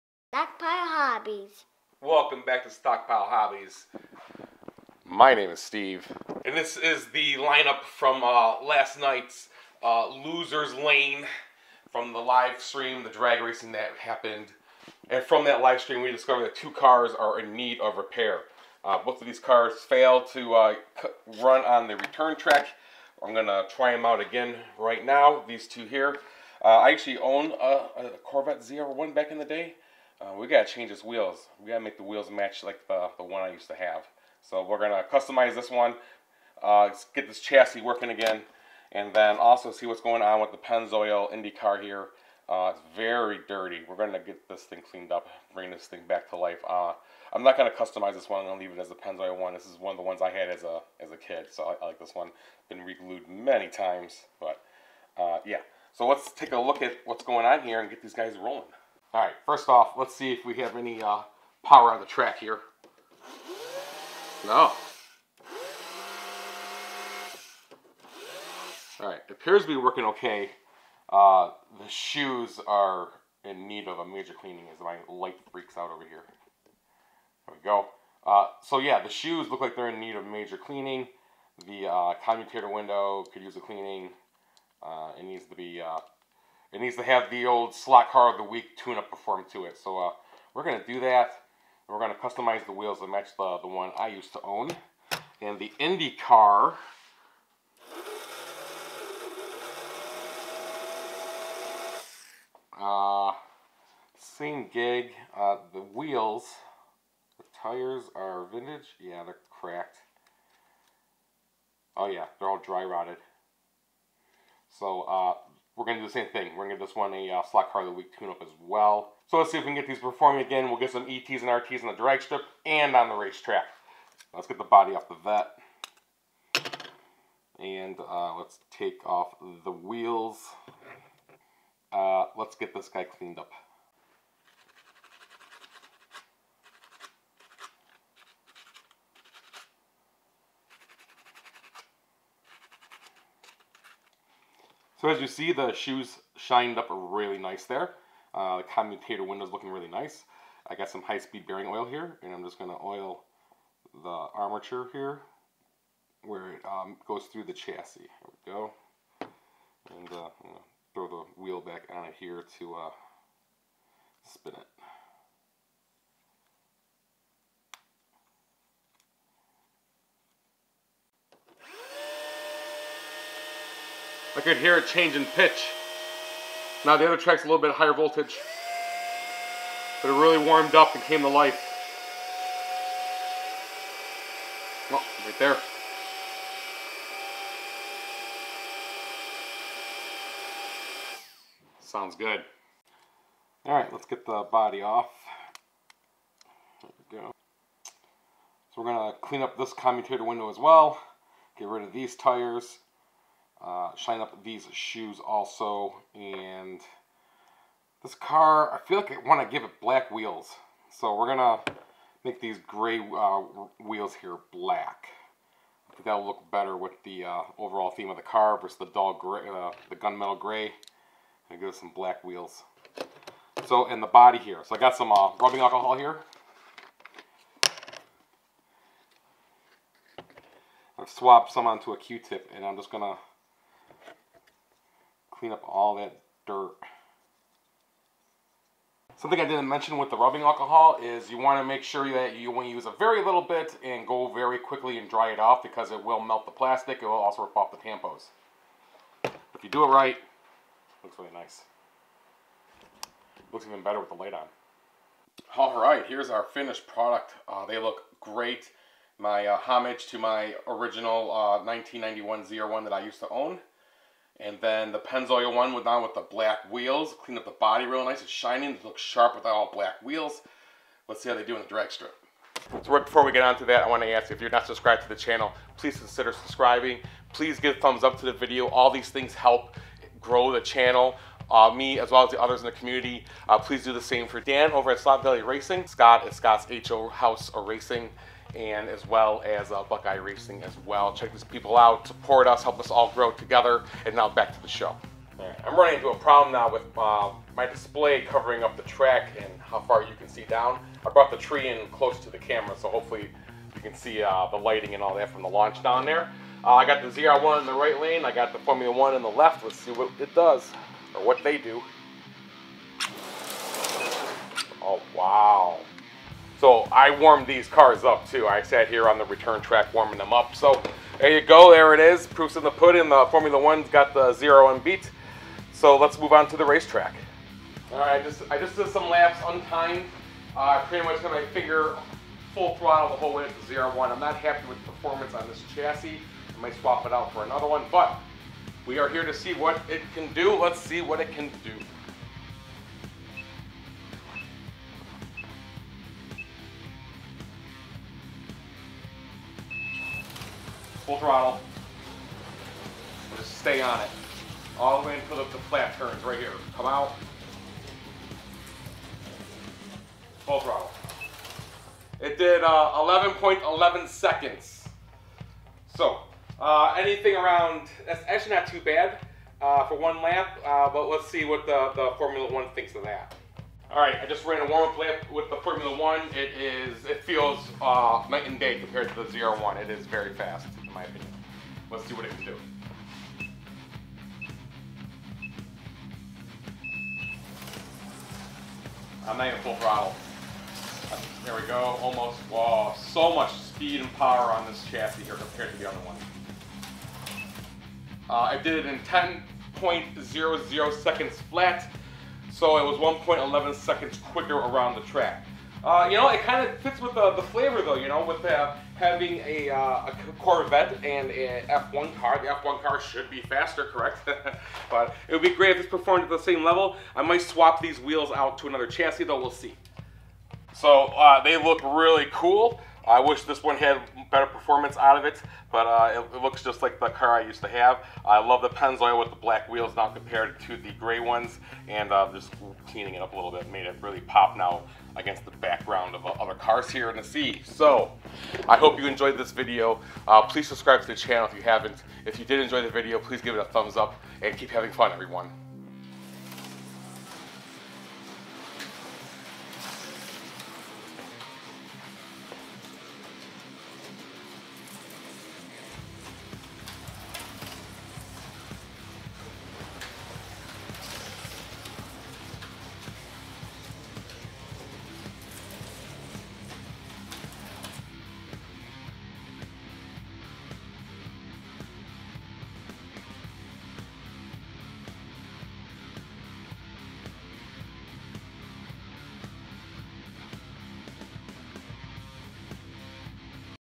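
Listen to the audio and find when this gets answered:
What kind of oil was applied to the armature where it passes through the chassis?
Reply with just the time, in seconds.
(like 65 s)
151 s.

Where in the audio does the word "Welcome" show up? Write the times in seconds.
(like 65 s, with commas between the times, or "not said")
1 s.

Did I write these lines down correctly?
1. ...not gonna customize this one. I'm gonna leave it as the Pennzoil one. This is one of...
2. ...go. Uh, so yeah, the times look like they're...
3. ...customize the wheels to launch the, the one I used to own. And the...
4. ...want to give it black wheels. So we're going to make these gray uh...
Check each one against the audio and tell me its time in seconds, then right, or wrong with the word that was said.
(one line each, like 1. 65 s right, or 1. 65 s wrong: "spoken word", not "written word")
1. 47 s right
2. 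77 s wrong: "shoes", not "times"
3. 92 s wrong: "match", not "launch"
4. 209 s right.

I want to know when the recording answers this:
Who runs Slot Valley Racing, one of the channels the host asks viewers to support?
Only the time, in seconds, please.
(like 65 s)
284 s.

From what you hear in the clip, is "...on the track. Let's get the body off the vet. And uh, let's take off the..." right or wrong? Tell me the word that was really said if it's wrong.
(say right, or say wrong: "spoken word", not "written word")
wrong: "racetrack", not "track".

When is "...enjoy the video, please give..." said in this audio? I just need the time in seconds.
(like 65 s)
442 s.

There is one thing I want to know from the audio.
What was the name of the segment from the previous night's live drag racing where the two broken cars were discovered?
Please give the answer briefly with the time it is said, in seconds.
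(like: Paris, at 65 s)
Losers Lane, at 10 s.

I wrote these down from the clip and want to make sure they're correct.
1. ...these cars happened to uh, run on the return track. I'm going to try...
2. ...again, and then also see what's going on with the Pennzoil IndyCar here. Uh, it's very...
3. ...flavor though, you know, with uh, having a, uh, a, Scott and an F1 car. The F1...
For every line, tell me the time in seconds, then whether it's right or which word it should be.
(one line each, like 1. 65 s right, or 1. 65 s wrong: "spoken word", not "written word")
1. 19 s wrong: "failed", not "happened"
2. 38 s right
3. 407 s wrong: "Corvette", not "Scott".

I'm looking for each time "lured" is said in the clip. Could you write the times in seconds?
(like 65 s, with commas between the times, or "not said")
not said.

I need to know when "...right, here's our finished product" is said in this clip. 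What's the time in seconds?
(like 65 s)
255 s.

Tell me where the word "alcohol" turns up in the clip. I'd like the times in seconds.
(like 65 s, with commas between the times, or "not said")
225 s, 240 s.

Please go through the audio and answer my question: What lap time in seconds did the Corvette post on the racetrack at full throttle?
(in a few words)
11.11 seconds.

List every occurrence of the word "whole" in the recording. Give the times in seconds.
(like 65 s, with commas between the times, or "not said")
333 s.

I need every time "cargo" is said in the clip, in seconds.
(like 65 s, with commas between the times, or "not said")
not said.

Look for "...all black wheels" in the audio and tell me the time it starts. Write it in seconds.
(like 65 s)
269 s.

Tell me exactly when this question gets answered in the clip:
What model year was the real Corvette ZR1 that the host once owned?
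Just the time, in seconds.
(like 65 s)
261 s.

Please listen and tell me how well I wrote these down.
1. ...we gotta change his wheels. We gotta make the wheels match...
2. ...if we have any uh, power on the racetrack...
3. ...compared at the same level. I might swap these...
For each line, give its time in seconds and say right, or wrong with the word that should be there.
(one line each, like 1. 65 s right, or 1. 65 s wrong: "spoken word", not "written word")
1. 30 s right
2. 60 s wrong: "track", not "racetrack"
3. 415 s wrong: "performed", not "compared".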